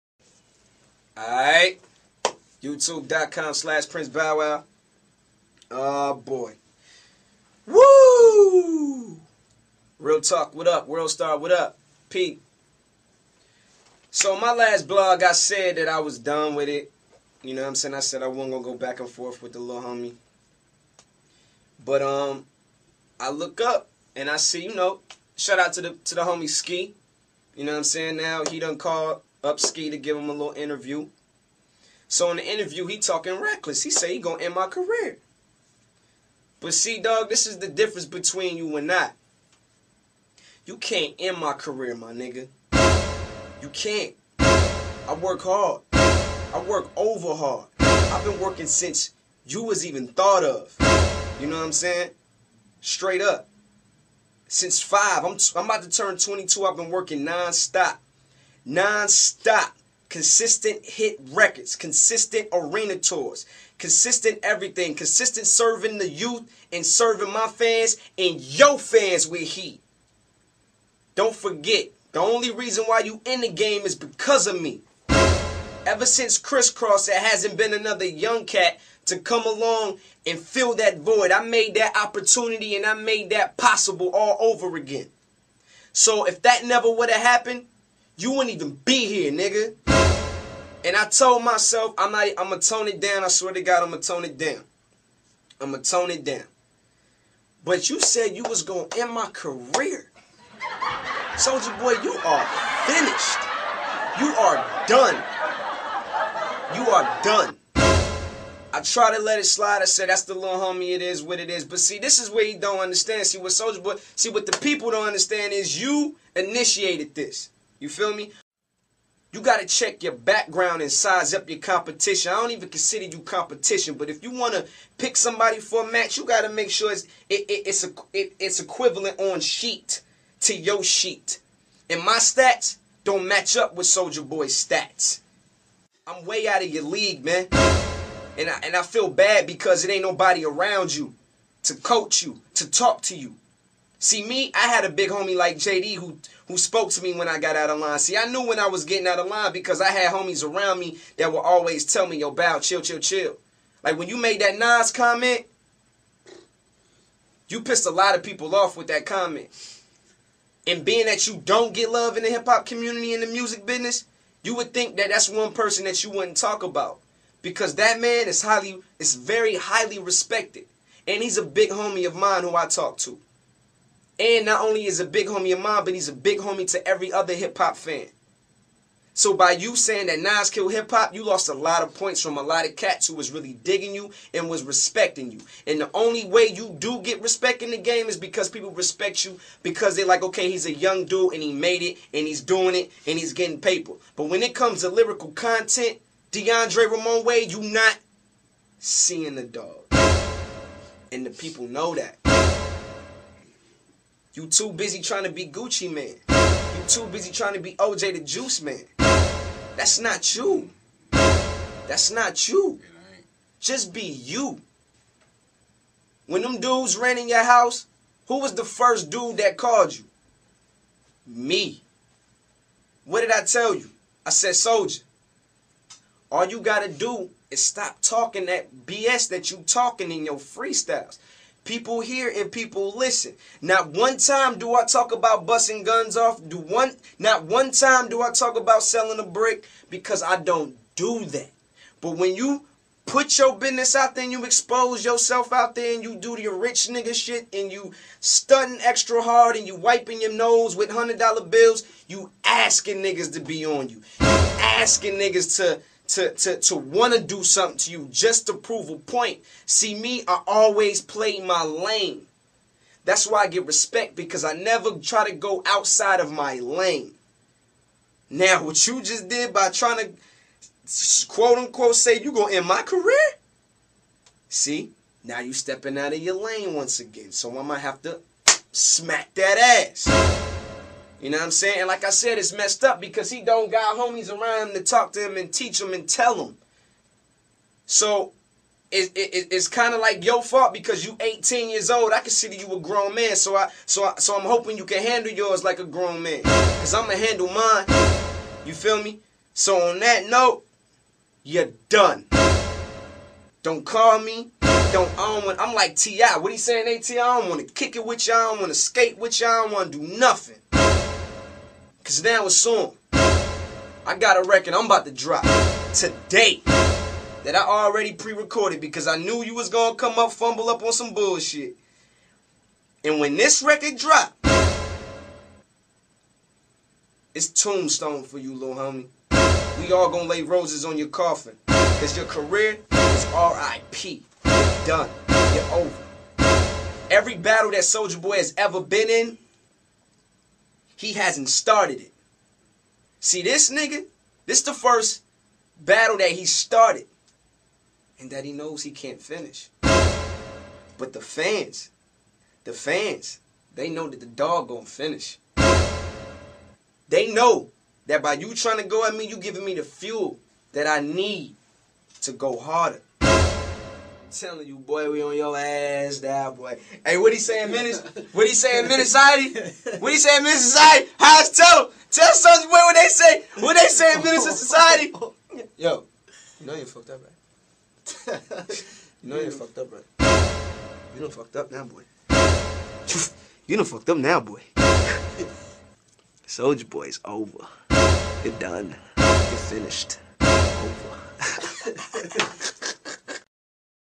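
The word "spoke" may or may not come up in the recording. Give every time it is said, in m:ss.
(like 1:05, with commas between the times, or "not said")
2:26.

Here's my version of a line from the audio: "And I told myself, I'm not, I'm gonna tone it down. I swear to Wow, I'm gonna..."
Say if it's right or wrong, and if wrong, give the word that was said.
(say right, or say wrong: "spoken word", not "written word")
wrong: "God", not "Wow".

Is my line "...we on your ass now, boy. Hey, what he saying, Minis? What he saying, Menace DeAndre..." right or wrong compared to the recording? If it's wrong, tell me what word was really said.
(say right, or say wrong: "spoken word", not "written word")
wrong: "What", not "DeAndre".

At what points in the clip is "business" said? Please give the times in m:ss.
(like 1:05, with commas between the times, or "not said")
2:43, 4:03.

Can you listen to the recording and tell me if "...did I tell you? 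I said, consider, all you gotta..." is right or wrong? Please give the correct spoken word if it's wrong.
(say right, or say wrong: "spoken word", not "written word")
wrong: "soldier", not "consider".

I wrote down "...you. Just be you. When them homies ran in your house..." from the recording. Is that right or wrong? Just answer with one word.
wrong.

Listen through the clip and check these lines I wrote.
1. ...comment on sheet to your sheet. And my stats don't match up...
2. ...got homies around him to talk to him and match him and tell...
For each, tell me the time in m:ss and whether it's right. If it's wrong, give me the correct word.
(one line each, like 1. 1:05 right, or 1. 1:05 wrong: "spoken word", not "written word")
1. 2:08 wrong: "equivalent", not "comment"
2. 4:43 wrong: "teach", not "match".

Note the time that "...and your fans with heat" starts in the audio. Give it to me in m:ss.
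1:08.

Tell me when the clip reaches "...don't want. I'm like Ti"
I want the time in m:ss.
5:05.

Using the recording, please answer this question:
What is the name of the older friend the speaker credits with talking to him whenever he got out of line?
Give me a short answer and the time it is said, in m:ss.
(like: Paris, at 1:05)
JD, at 2:25.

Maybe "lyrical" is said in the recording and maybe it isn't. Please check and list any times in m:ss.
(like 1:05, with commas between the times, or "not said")
3:14.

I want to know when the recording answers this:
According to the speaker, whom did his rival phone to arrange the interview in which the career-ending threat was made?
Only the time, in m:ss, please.
0:29.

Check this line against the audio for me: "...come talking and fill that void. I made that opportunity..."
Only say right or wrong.
wrong.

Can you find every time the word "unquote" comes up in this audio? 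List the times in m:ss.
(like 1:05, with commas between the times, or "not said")
4:31.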